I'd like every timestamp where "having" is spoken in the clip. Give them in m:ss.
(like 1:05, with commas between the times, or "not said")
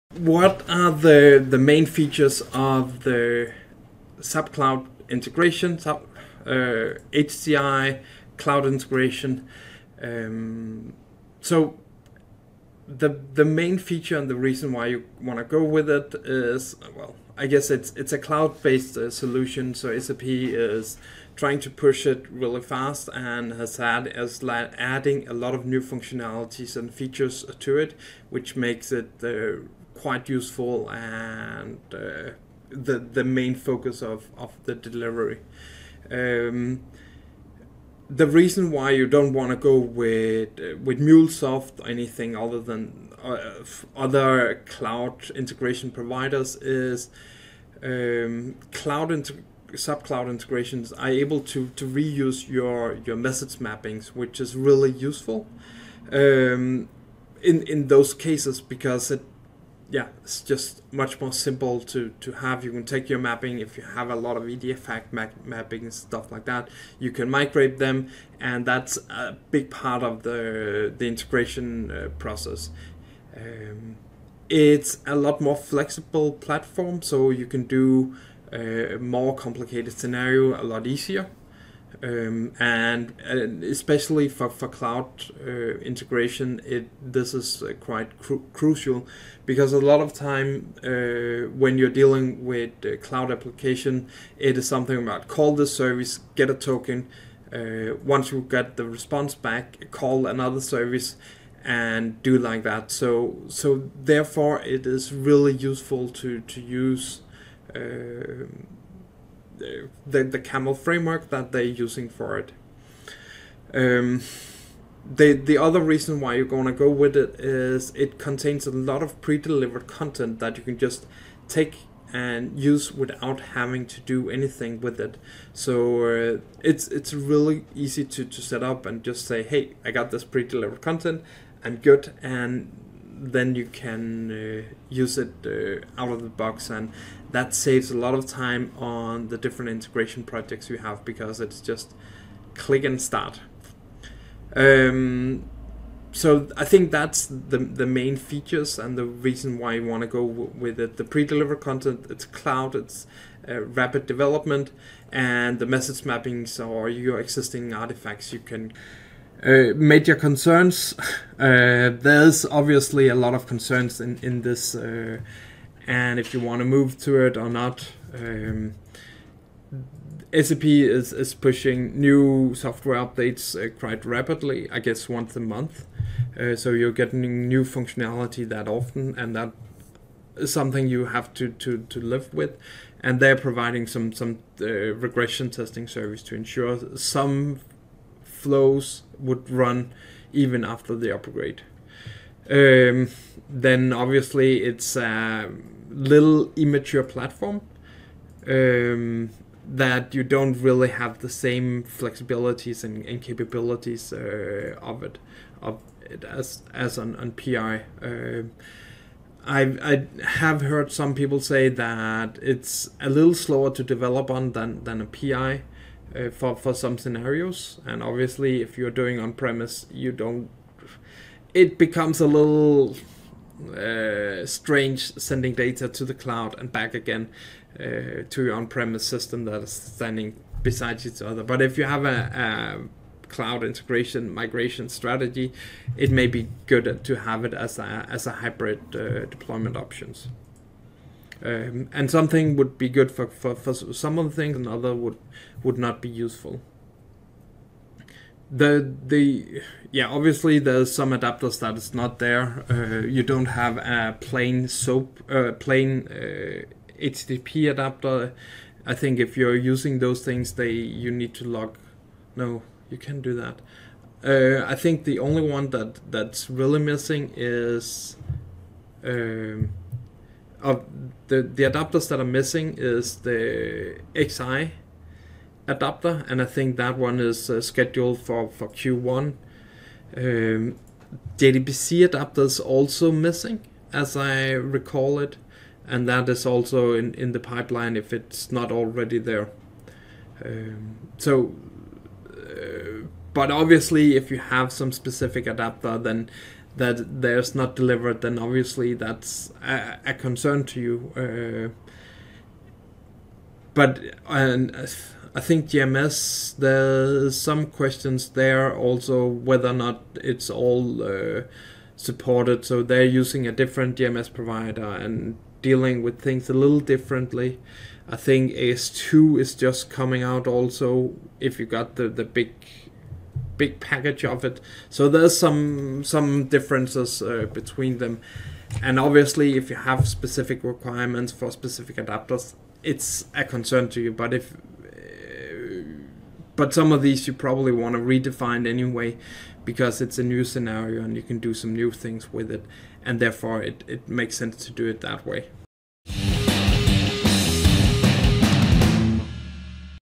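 2:03.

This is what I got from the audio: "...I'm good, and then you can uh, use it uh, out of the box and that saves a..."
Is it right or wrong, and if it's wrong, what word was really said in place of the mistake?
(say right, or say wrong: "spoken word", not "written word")
right.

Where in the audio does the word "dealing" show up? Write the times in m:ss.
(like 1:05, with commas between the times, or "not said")
1:31, 5:15.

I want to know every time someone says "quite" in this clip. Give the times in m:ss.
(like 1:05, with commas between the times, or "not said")
0:30, 1:27, 2:53.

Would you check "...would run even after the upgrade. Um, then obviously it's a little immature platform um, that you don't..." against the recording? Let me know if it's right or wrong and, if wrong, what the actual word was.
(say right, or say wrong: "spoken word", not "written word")
right.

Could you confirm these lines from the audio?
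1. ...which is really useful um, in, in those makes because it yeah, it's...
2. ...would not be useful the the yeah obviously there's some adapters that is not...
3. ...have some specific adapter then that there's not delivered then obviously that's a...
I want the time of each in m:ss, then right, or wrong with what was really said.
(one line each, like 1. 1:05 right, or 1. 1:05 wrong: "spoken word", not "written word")
1. 0:54 wrong: "cases", not "makes"
2. 4:05 right
3. 4:54 right.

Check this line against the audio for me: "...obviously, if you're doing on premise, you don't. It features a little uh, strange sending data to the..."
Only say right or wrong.
wrong.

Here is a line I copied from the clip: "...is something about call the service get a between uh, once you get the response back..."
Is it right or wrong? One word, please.
wrong.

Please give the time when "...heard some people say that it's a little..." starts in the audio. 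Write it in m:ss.
3:30.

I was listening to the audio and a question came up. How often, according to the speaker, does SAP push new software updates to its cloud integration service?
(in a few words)
Once a month.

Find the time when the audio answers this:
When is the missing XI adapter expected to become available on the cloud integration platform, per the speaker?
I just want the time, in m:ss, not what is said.
4:38.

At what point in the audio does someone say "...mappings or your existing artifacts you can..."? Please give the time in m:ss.
2:36.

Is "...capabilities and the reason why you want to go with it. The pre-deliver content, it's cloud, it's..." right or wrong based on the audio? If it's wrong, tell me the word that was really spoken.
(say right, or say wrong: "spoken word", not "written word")
wrong: "features", not "capabilities".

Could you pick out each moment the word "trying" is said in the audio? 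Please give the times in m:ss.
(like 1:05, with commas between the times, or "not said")
0:21.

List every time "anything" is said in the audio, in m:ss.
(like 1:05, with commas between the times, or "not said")
0:41, 2:04.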